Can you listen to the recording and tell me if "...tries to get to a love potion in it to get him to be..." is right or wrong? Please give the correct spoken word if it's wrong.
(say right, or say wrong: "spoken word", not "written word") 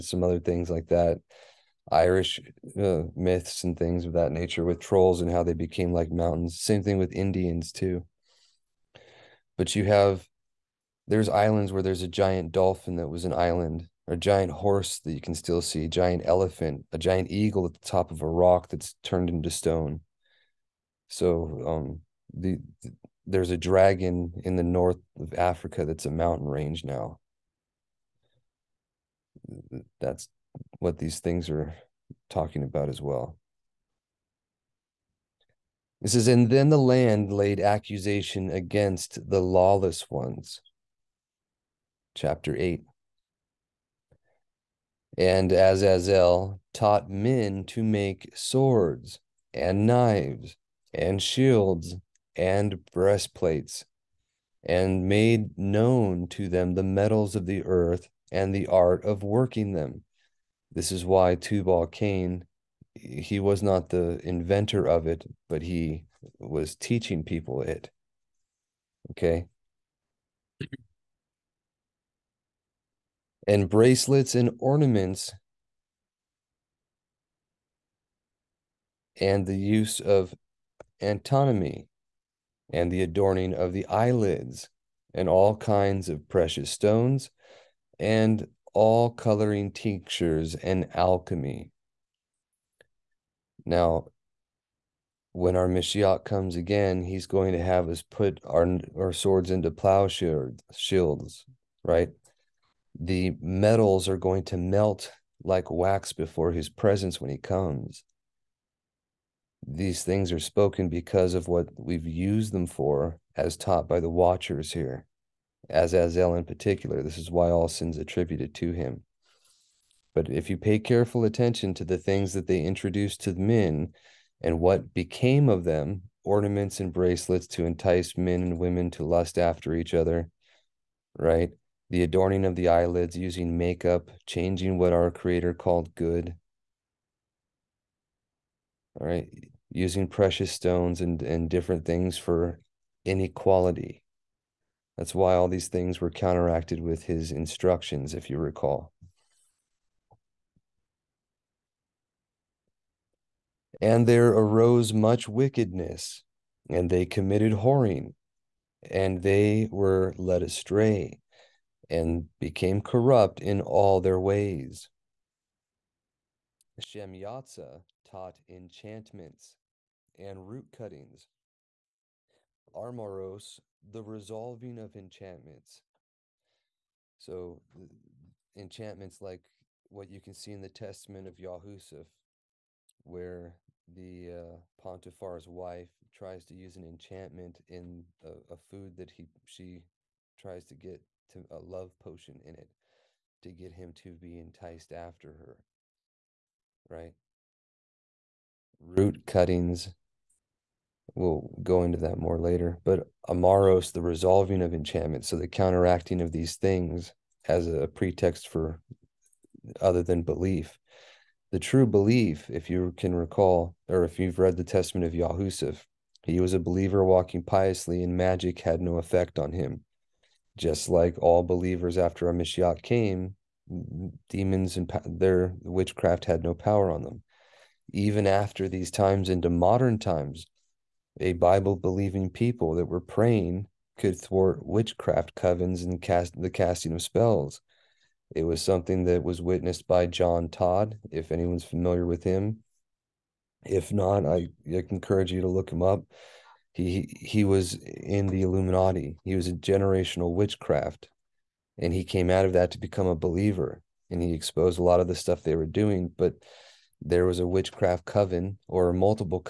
right.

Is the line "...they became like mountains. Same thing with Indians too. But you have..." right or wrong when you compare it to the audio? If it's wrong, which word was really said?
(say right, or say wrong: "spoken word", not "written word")
right.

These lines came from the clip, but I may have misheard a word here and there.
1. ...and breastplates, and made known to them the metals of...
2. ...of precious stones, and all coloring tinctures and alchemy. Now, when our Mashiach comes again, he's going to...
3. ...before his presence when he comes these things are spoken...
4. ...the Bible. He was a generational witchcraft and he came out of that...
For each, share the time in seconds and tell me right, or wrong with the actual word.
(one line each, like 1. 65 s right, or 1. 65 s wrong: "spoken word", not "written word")
1. 52 s right
2. 86 s right
3. 106 s right
4. 248 s wrong: "Illuminati", not "Bible".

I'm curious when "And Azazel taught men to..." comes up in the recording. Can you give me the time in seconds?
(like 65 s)
45 s.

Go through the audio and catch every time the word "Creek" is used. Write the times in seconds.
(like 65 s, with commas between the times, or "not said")
not said.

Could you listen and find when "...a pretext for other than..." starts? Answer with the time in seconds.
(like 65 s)
207 s.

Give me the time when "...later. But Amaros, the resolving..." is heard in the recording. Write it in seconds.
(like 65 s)
202 s.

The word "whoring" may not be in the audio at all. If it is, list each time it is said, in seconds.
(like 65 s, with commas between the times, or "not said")
157 s.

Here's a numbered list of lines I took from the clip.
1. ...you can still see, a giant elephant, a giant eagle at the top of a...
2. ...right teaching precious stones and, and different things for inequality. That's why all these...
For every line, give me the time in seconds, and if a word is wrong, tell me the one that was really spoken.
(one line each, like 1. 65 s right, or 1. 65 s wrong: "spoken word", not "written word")
1. 15 s right
2. 139 s wrong: "using", not "teaching".